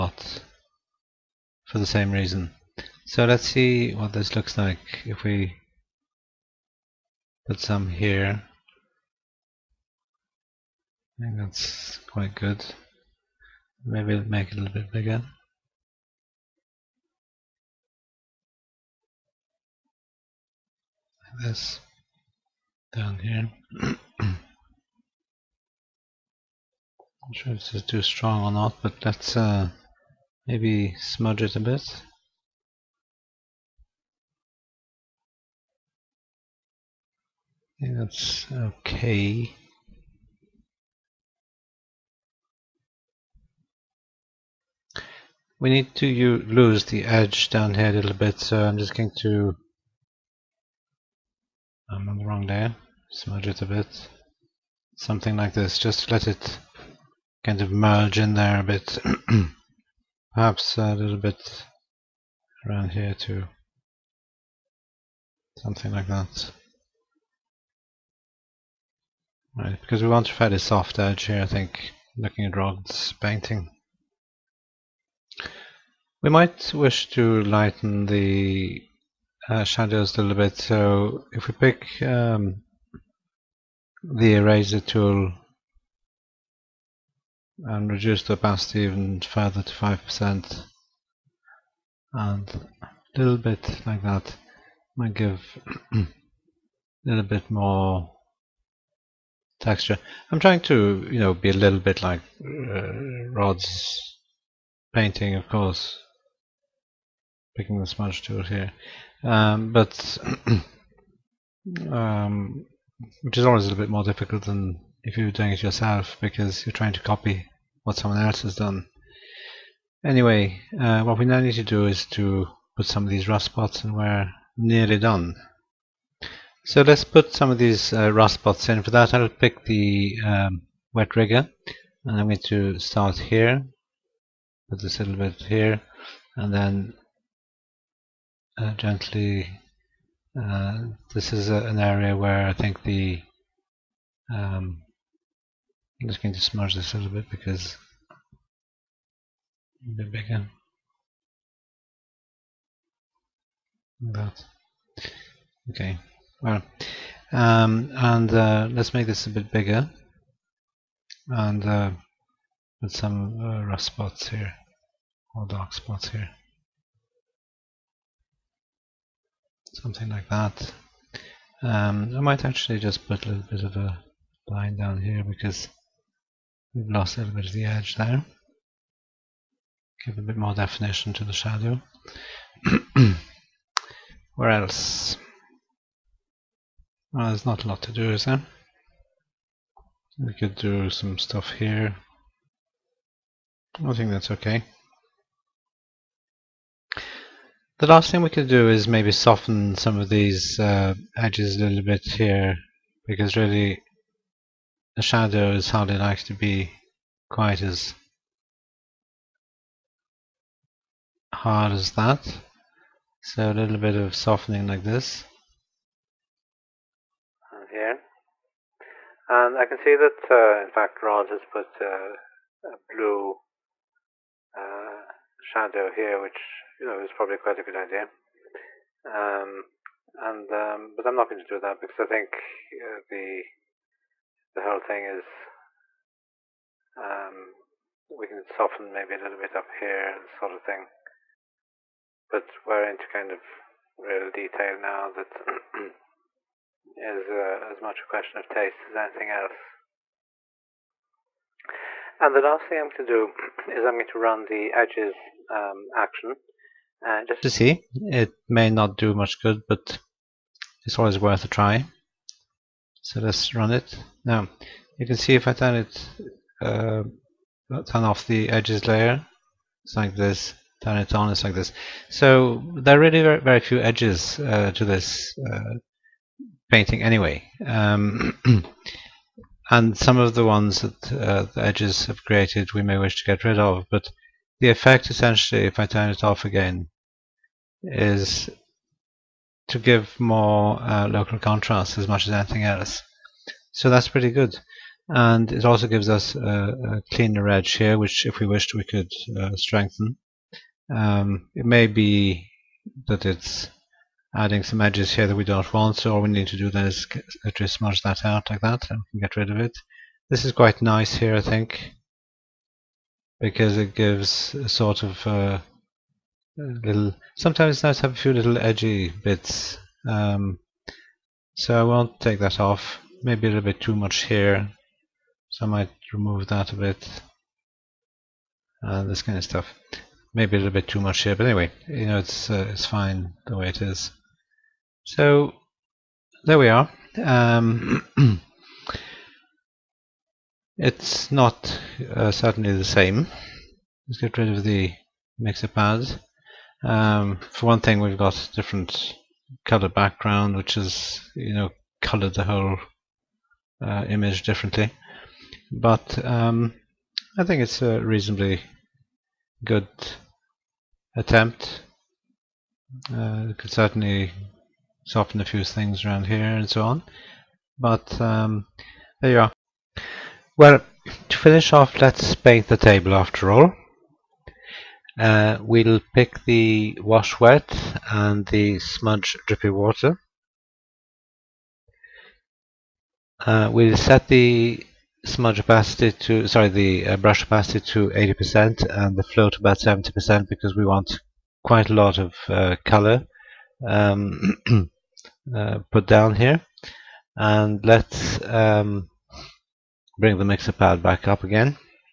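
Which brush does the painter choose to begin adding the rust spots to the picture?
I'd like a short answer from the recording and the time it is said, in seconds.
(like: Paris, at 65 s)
wet rigger, at 130 s.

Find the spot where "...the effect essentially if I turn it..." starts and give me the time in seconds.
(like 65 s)
284 s.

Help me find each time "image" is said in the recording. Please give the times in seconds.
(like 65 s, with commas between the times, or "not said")
354 s.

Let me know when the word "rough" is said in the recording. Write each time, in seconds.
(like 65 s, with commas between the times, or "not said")
163 s.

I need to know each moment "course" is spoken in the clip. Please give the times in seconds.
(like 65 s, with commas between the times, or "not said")
105 s.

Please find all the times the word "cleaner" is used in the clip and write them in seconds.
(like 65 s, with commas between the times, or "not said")
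297 s.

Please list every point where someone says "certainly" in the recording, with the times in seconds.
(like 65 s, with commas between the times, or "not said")
342 s, 363 s.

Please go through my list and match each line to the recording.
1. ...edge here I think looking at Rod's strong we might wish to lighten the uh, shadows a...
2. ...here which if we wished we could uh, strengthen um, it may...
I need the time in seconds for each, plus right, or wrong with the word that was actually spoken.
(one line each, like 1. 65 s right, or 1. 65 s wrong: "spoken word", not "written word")
1. 70 s wrong: "painting", not "strong"
2. 297 s right.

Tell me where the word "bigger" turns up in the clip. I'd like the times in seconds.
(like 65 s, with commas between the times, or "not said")
14 s, 150 s, 159 s.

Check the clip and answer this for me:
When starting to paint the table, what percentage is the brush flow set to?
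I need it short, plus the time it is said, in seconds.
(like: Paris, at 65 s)
70%, at 389 s.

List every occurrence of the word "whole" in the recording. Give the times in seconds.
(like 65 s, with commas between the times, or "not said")
234 s, 352 s.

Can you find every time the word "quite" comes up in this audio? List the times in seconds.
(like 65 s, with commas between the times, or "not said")
12 s, 207 s, 227 s, 310 s, 391 s.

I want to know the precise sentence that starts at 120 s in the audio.
Anyway, uh, what we now need to do is to put some of these rust spots and we're nearly done.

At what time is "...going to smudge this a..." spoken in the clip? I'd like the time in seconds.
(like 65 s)
146 s.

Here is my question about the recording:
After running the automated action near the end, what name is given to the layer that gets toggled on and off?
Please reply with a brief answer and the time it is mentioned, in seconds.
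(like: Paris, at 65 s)
edges layer, at 268 s.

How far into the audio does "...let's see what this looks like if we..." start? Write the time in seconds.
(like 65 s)
3 s.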